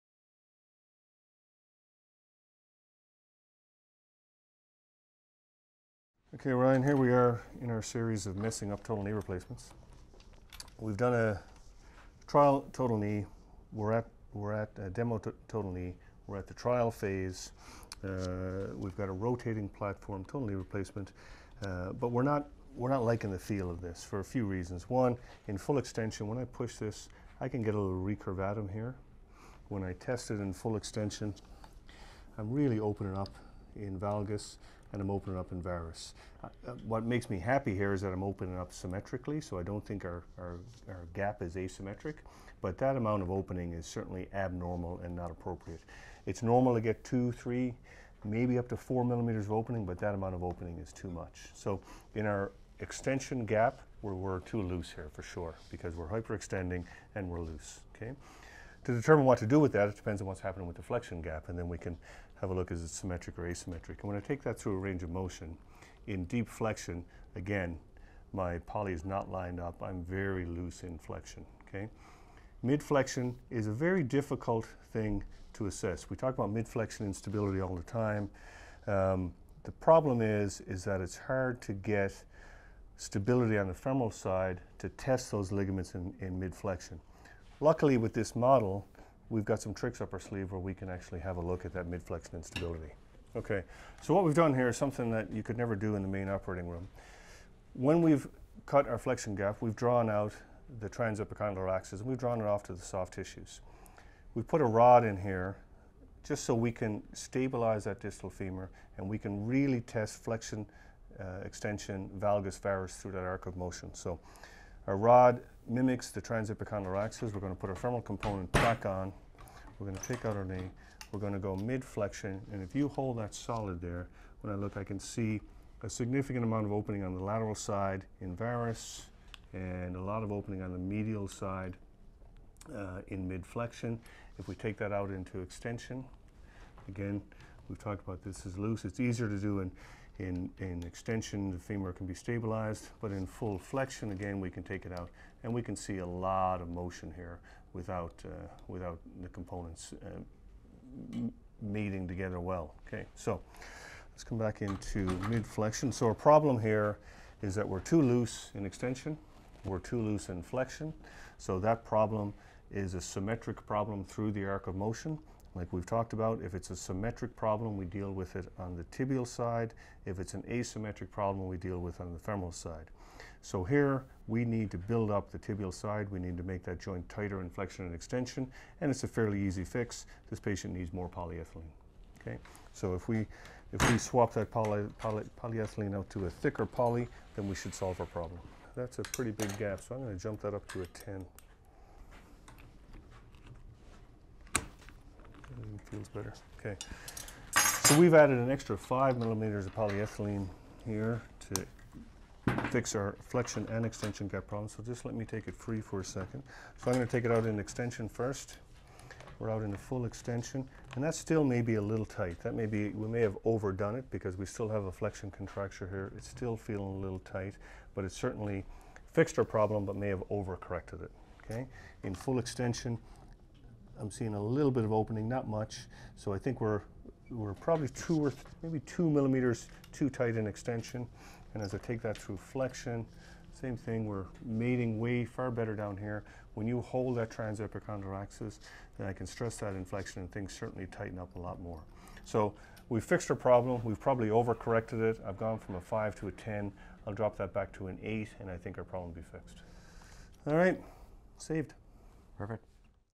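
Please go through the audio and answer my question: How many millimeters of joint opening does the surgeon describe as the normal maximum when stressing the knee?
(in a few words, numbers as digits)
4.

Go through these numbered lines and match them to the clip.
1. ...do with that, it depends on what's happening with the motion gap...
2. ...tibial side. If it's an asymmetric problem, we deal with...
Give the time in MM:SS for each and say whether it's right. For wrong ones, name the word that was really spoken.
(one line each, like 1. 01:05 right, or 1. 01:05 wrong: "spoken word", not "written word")
1. 00:59 wrong: "flexion", not "motion"
2. 02:48 right.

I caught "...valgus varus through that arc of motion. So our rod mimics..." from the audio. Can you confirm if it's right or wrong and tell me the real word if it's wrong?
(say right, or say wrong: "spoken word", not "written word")
right.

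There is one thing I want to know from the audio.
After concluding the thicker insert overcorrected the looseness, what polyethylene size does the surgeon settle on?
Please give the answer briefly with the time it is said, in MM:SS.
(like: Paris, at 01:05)
8, at 04:08.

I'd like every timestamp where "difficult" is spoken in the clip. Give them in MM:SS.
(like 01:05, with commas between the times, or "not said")
01:14.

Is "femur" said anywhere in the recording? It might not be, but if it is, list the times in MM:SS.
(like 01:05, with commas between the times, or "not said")
01:48, 02:21.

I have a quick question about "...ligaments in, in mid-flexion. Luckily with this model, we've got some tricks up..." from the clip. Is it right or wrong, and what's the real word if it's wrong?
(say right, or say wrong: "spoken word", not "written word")
right.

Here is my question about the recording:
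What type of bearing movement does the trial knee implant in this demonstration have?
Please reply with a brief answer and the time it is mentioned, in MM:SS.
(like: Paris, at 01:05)
rotating platform, at 00:19.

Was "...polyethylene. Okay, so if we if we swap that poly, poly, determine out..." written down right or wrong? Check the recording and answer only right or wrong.
wrong.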